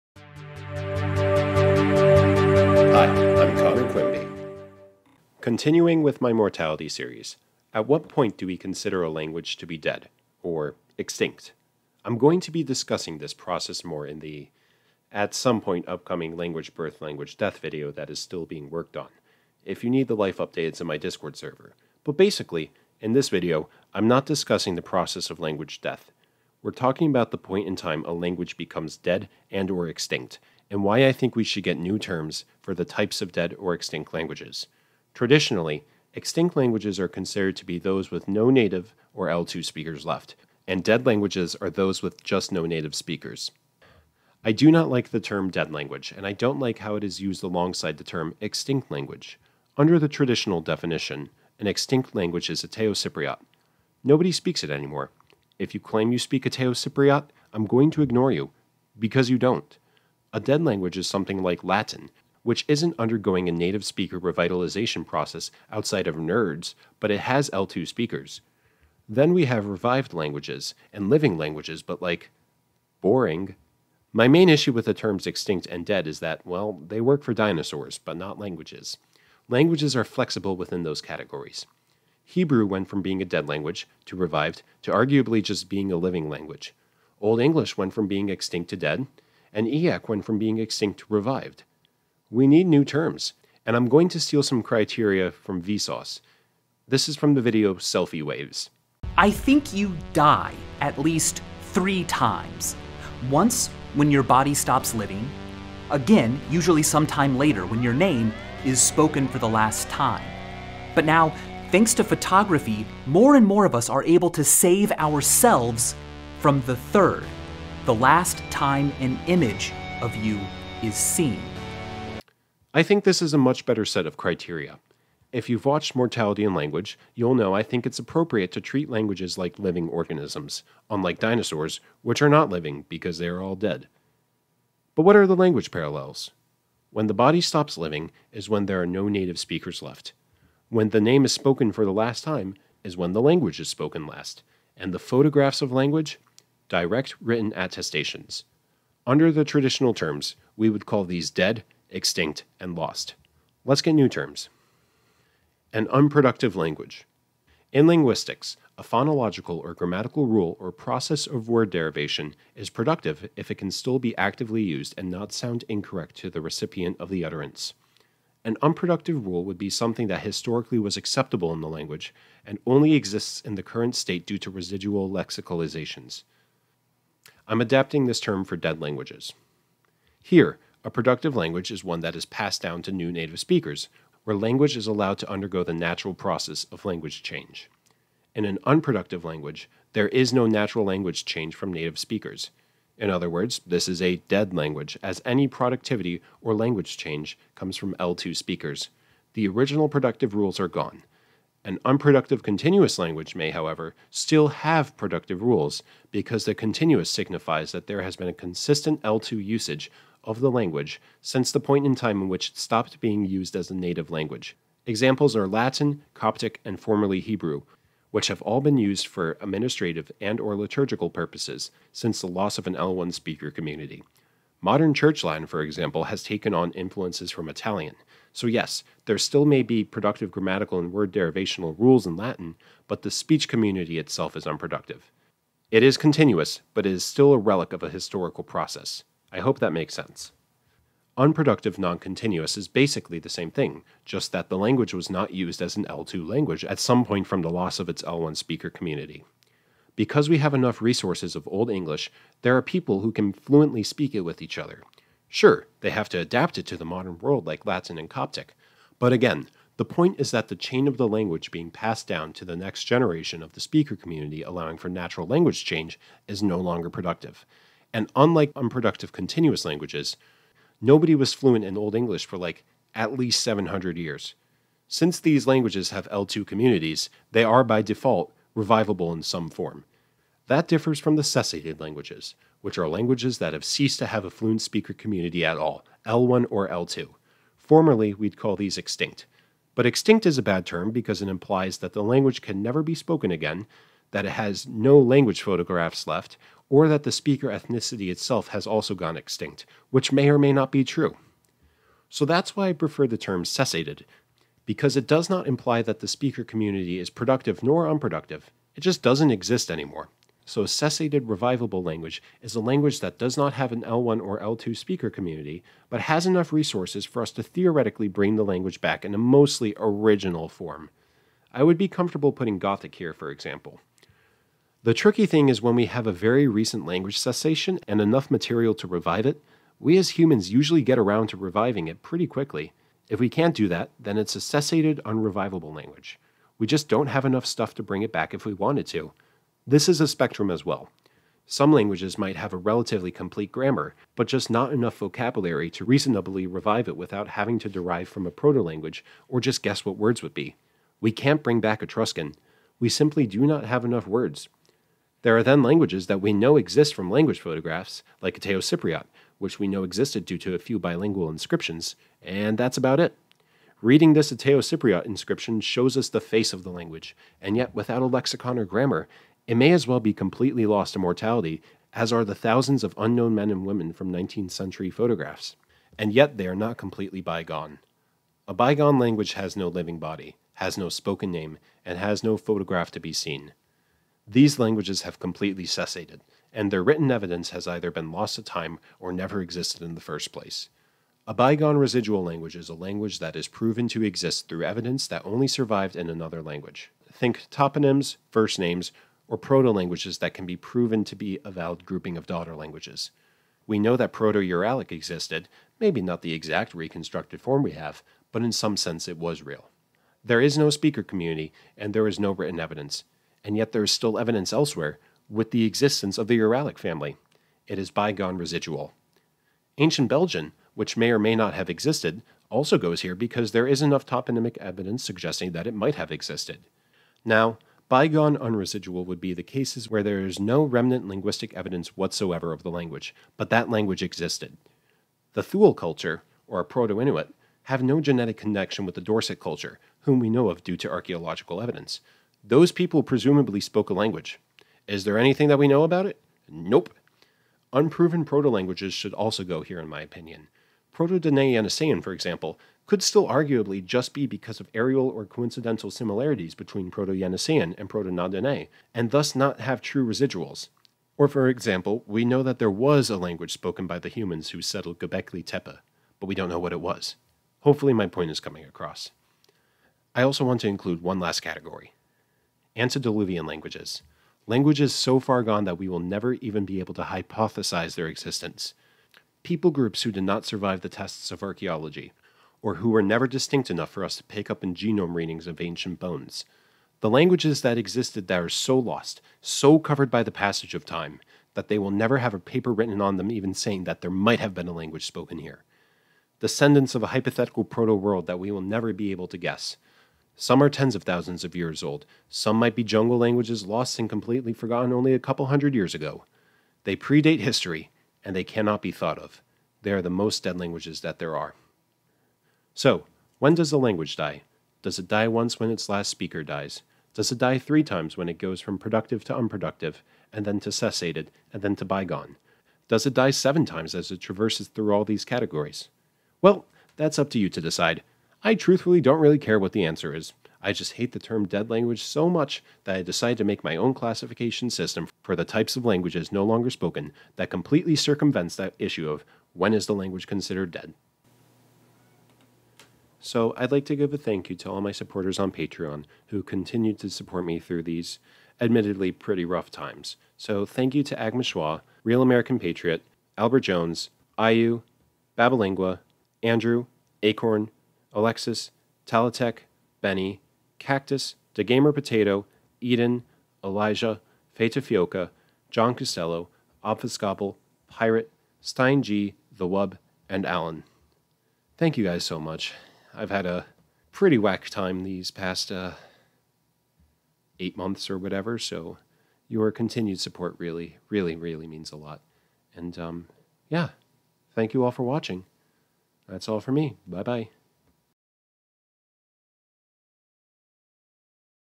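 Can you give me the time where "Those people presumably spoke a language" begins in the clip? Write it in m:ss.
7:22.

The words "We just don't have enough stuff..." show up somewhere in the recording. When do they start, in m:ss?
5:36.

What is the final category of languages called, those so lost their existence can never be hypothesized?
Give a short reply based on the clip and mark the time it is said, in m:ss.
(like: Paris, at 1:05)
Antediluvian languages, at 7:52.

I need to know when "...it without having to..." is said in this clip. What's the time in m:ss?
5:46.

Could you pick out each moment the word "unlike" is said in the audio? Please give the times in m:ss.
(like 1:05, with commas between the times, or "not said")
2:10, 4:28.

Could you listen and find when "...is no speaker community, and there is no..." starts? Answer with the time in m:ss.
6:50.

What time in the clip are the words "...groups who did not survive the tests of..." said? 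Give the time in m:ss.
7:59.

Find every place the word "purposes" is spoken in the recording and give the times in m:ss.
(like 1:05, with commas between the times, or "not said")
3:41.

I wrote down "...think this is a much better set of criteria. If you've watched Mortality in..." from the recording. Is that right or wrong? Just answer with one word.
right.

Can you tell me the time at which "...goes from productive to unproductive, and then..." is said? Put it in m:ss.
8:38.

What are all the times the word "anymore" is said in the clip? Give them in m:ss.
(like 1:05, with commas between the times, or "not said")
0:54, 5:09.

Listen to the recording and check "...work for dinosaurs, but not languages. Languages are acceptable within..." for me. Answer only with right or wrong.
wrong.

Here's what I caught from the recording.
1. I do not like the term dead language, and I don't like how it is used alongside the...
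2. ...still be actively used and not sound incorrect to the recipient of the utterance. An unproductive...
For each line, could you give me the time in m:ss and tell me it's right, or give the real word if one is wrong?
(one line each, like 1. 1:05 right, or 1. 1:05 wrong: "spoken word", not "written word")
1. 0:44 right
2. 2:43 right.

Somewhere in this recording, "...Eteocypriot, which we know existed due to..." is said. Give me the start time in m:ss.
5:58.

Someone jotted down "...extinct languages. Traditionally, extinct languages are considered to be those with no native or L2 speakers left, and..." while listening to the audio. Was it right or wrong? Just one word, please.
right.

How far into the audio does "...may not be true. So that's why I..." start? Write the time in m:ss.
5:00.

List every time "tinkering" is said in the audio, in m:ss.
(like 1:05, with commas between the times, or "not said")
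not said.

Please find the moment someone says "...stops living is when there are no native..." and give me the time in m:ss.
2:17.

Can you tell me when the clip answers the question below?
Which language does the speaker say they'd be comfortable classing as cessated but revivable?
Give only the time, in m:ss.
5:22.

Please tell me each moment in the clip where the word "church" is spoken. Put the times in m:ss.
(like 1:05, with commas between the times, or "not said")
3:44.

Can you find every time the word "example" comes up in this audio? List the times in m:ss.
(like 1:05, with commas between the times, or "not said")
3:34, 3:45, 5:23, 7:32, 7:41.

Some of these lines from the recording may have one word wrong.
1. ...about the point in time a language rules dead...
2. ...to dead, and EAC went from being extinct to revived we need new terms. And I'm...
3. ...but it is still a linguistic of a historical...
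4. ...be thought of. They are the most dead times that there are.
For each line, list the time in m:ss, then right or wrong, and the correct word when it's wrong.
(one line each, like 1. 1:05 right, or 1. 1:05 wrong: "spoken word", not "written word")
1. 0:27 wrong: "becomes", not "rules"
2. 1:28 right
3. 3:56 wrong: "relic", not "linguistic"
4. 8:28 wrong: "languages", not "times".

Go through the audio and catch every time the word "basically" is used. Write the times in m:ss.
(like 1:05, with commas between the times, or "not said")
0:22, 4:02.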